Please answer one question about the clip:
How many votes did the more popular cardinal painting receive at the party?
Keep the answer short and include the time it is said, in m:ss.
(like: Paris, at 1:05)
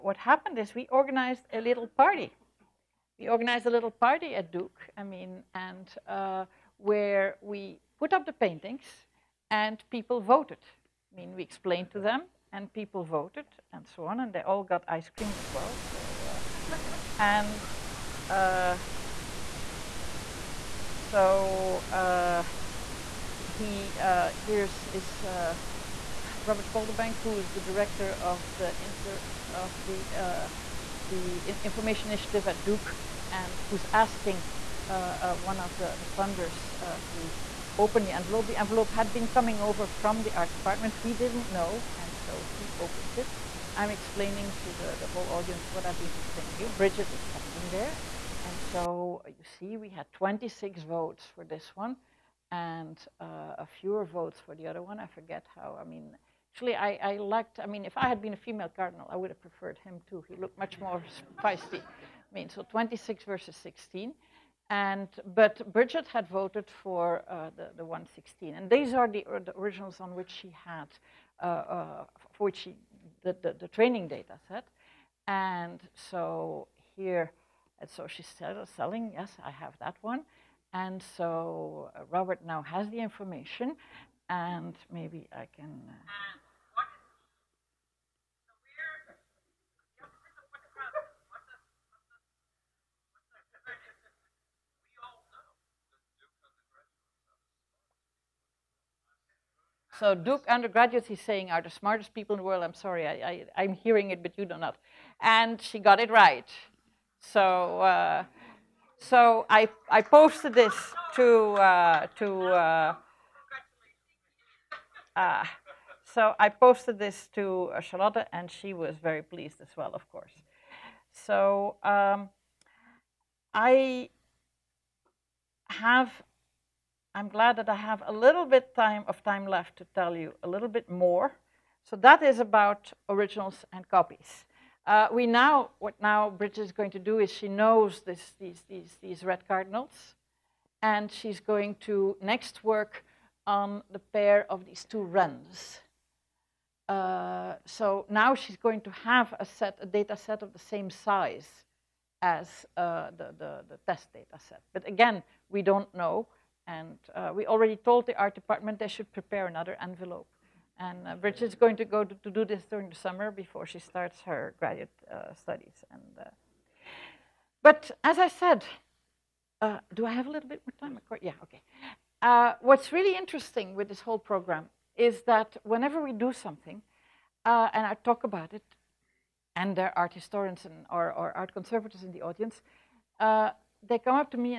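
26, at 0:50.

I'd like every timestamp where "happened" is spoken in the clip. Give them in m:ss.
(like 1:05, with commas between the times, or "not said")
0:00.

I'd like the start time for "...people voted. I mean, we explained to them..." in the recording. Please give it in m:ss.
0:09.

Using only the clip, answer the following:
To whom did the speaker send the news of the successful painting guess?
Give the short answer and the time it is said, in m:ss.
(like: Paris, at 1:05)
Charlotte, at 1:57.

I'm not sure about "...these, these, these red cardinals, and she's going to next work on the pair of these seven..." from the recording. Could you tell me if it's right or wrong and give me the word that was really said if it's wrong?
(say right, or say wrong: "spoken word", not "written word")
wrong: "two", not "seven".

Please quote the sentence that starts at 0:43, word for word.
I'm explaining to the, the whole audience what I've been explaining you.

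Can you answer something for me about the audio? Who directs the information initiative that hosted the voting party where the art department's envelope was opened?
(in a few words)
Robert Calderbank.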